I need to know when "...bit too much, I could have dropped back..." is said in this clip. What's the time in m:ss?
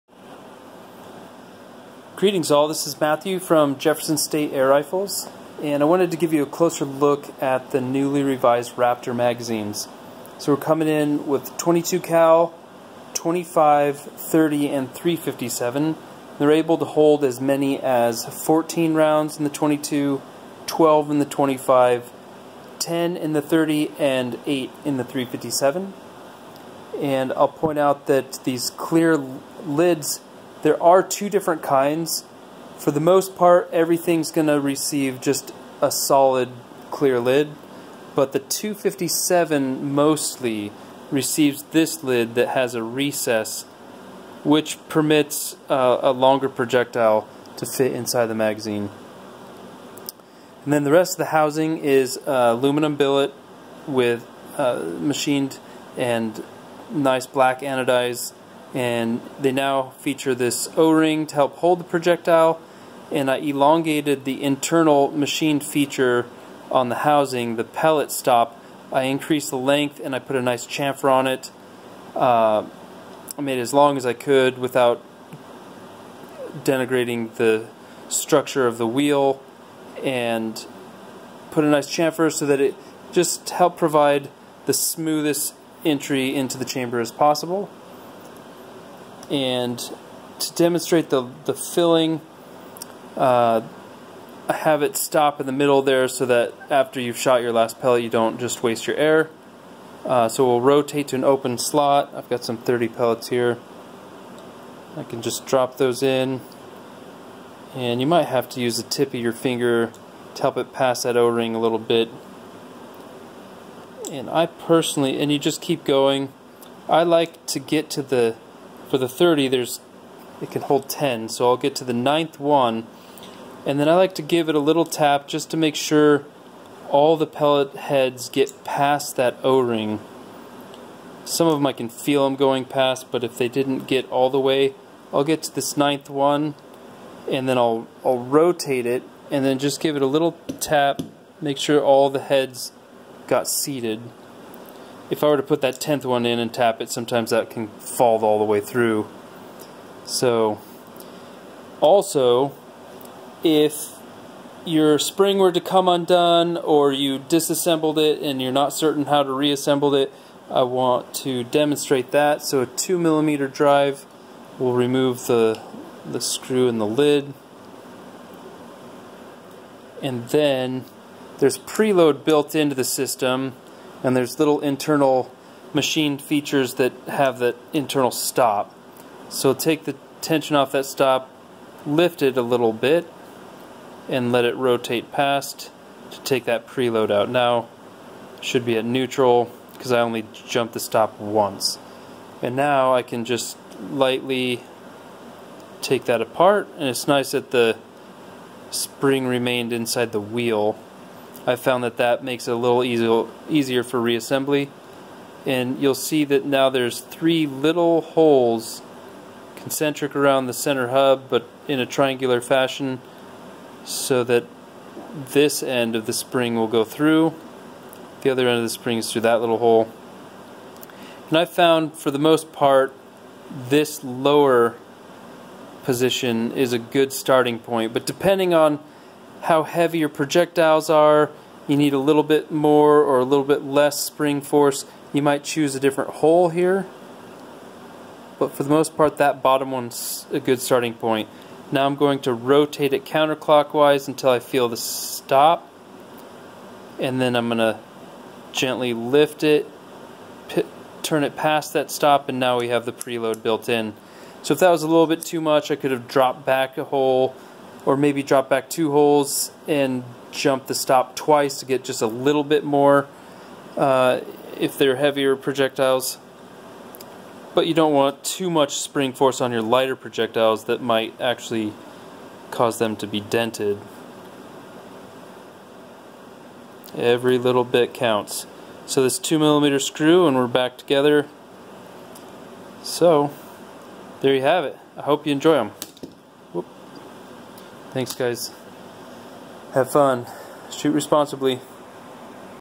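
4:15.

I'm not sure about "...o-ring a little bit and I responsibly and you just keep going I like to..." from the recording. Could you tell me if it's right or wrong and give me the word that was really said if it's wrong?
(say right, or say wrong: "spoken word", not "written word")
wrong: "personally", not "responsibly".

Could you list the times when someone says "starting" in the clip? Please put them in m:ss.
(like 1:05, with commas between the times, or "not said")
3:47, 4:00.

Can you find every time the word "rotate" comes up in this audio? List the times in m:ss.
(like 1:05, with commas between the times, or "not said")
1:40, 2:18, 3:04, 4:02.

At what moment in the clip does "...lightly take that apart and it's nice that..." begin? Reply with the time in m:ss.
3:13.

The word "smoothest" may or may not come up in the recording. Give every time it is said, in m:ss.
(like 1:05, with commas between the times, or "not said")
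1:24.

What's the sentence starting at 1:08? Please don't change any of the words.
I increased the length and I put a nice chamfer on it.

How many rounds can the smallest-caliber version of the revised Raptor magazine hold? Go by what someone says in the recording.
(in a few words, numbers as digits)
14.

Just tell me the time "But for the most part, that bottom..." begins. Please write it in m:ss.
3:58.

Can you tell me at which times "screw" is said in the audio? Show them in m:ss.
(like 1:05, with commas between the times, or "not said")
2:46, 4:39.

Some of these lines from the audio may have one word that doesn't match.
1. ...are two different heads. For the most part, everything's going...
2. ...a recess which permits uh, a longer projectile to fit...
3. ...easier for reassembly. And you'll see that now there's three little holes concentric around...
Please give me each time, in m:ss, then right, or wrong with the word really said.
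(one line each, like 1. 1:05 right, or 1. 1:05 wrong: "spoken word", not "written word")
1. 0:30 wrong: "kinds", not "heads"
2. 0:42 right
3. 3:23 right.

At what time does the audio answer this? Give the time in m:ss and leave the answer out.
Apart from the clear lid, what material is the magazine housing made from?
0:52.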